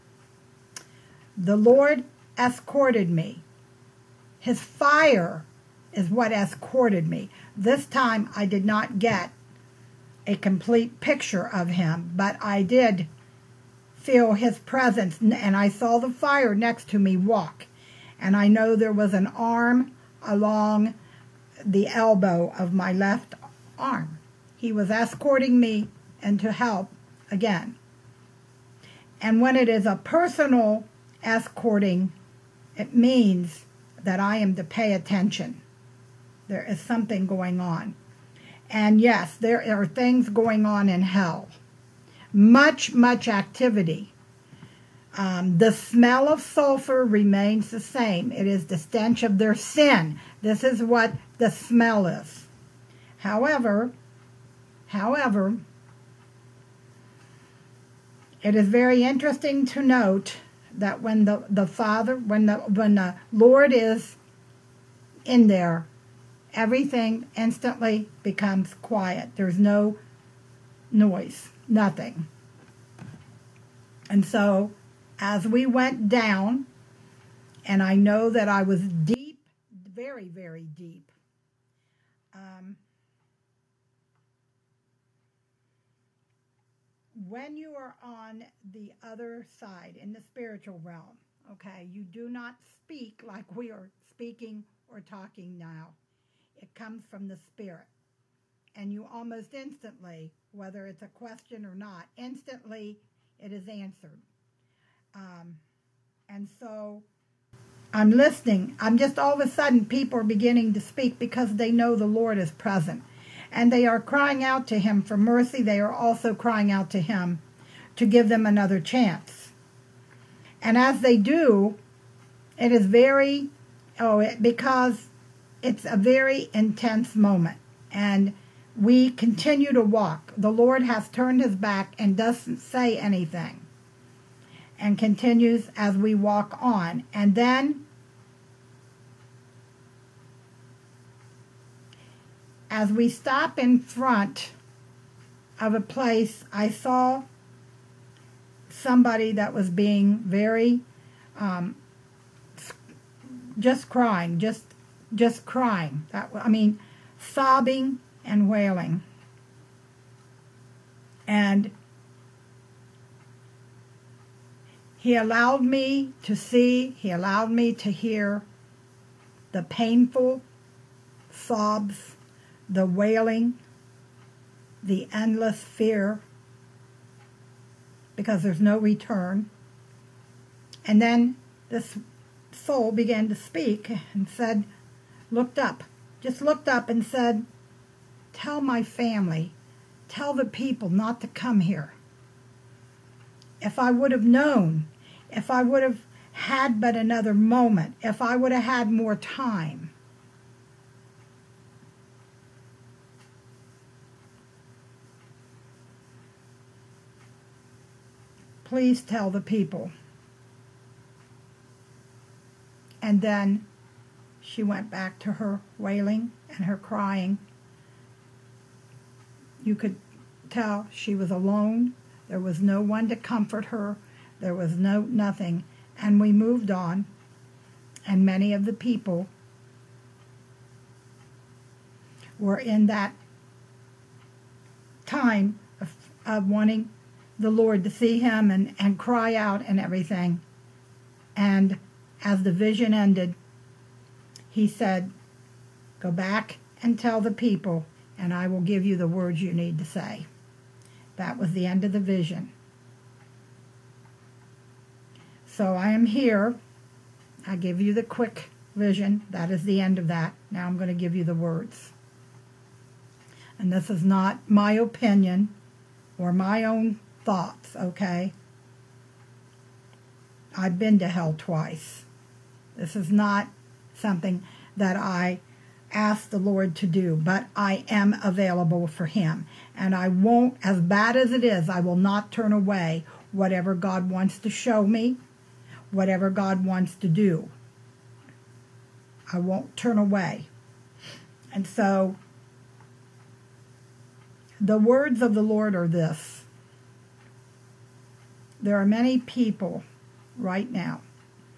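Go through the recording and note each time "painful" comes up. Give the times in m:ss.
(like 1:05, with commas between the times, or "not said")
2:49.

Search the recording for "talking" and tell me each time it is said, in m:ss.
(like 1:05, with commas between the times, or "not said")
1:35.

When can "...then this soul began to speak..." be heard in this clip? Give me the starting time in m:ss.
3:01.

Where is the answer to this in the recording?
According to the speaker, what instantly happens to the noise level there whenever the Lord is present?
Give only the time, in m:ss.
1:08.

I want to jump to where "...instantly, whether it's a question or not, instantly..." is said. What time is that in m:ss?
1:39.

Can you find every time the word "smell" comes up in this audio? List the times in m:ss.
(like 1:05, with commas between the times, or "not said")
0:45, 0:51.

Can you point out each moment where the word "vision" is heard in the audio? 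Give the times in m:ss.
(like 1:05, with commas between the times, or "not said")
4:02, 4:12, 4:18.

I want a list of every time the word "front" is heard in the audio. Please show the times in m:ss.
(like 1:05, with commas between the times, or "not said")
2:23.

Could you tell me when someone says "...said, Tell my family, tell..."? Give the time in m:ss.
3:07.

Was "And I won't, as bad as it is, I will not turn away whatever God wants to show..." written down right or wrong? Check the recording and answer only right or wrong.
right.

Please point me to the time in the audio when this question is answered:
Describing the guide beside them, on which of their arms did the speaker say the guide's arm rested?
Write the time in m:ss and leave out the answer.
0:22.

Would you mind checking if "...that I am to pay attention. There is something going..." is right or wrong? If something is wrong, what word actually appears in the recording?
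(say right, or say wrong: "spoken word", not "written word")
right.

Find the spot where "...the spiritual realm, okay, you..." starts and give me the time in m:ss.
1:30.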